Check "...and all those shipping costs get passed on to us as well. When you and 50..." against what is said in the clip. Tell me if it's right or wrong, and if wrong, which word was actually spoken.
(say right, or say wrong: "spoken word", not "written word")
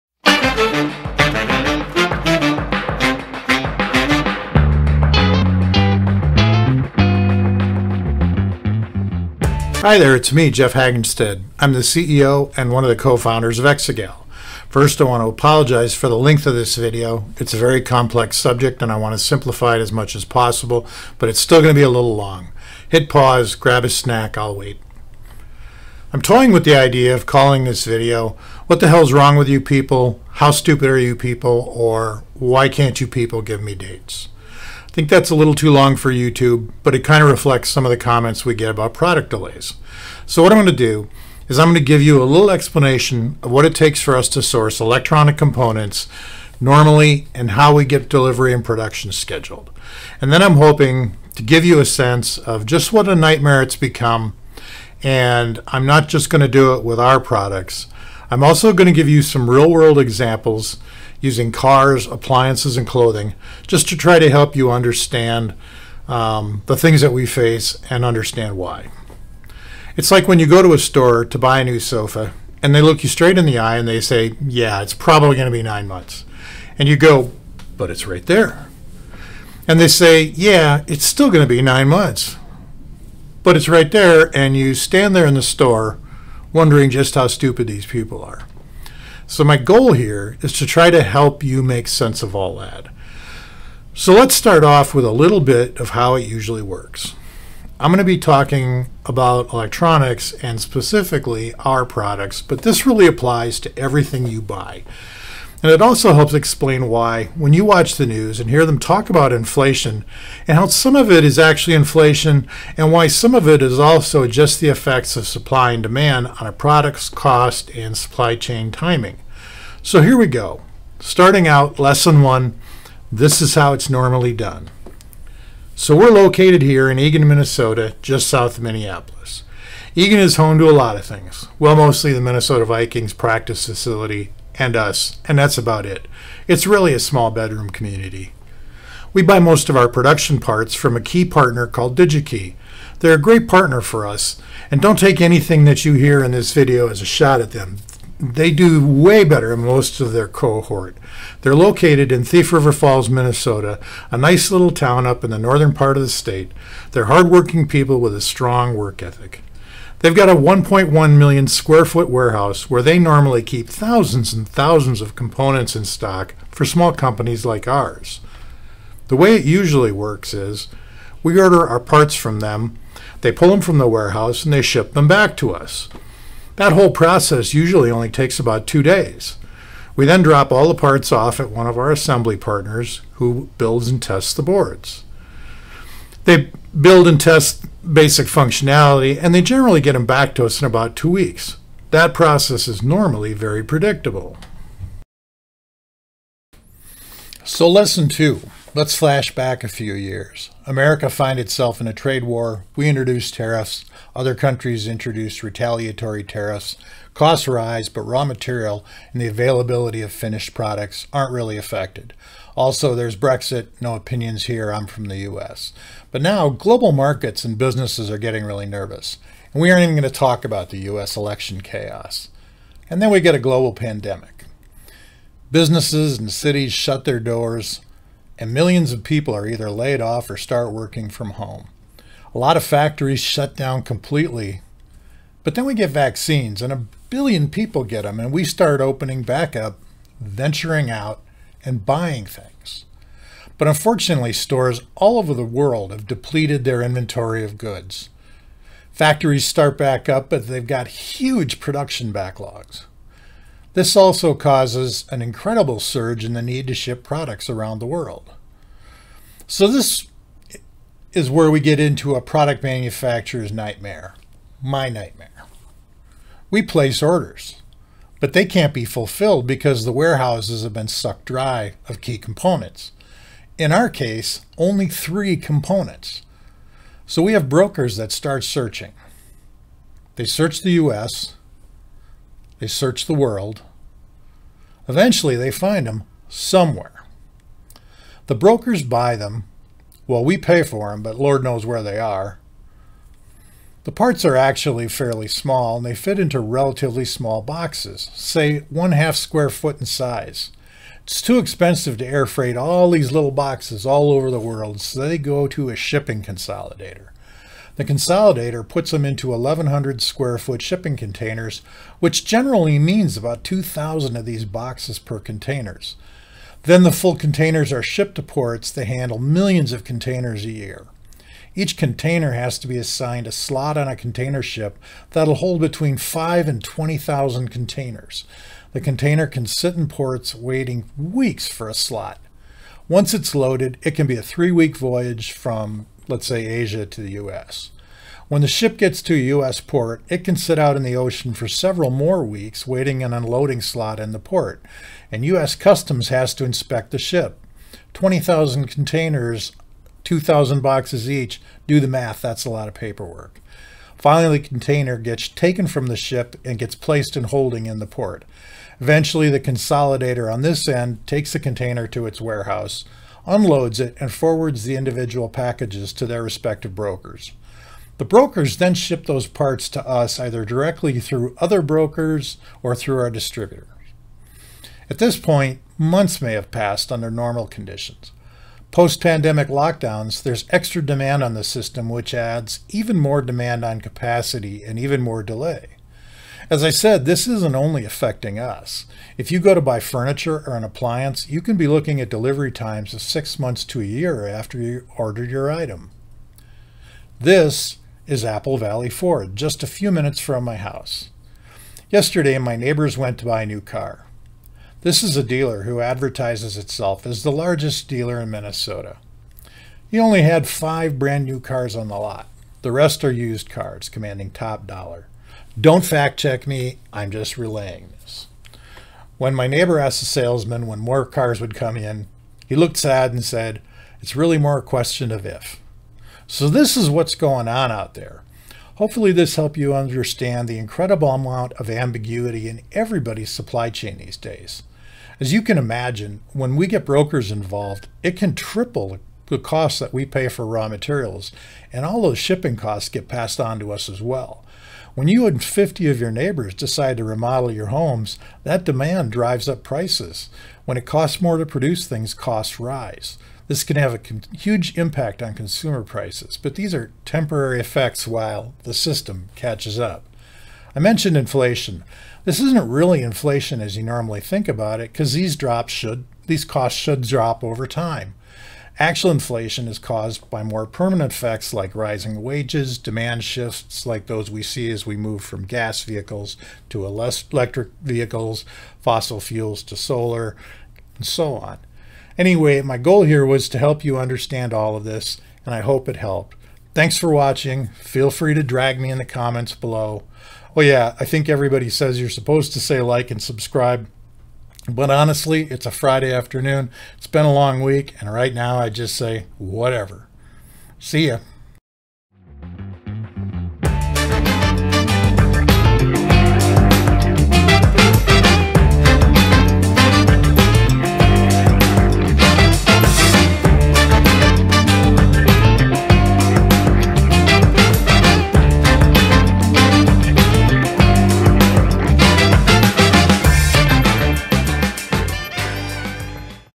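right.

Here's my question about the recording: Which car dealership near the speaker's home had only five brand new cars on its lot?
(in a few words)
Apple Valley Ford.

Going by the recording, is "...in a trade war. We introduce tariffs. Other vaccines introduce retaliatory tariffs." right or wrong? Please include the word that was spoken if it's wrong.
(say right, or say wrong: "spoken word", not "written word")
wrong: "countries", not "vaccines".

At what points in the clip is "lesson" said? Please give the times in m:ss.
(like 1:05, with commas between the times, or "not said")
2:01, 3:17.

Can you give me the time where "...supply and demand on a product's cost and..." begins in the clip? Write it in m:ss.
1:55.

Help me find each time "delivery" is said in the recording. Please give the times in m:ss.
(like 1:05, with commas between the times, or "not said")
0:48, 6:32.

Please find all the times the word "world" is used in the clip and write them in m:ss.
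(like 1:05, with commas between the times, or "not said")
0:59, 4:05, 4:17, 4:43, 5:04.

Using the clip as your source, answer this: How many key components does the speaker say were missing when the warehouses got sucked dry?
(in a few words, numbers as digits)
3.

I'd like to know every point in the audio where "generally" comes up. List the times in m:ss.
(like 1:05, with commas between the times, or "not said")
3:09, 5:12.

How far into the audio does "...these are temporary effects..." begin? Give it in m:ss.
7:36.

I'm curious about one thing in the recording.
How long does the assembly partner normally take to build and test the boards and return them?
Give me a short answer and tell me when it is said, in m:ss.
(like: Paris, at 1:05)
2 weeks, at 3:10.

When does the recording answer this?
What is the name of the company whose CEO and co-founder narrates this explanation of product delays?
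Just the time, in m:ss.
0:13.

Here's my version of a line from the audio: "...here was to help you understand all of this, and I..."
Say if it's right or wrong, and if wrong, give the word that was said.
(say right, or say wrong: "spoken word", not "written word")
right.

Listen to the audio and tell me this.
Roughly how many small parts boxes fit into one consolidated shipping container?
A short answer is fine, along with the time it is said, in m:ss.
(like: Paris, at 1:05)
2,000, at 5:13.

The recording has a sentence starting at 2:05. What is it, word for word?
So we're located here in Eagan, Minnesota, just south of Minneapolis.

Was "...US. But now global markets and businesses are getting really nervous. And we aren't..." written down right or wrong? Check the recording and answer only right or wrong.
right.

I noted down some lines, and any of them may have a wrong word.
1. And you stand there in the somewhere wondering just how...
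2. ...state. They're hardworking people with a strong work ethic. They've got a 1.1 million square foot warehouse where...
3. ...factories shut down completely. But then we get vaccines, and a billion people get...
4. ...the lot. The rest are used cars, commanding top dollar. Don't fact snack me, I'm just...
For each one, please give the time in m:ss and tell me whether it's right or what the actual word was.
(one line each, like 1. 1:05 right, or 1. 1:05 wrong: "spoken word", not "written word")
1. 1:24 wrong: "store", not "somewhere"
2. 2:36 right
3. 3:52 right
4. 6:51 wrong: "check", not "snack".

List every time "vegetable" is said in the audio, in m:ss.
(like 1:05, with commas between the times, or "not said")
not said.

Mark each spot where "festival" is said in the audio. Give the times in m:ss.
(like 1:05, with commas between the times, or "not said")
not said.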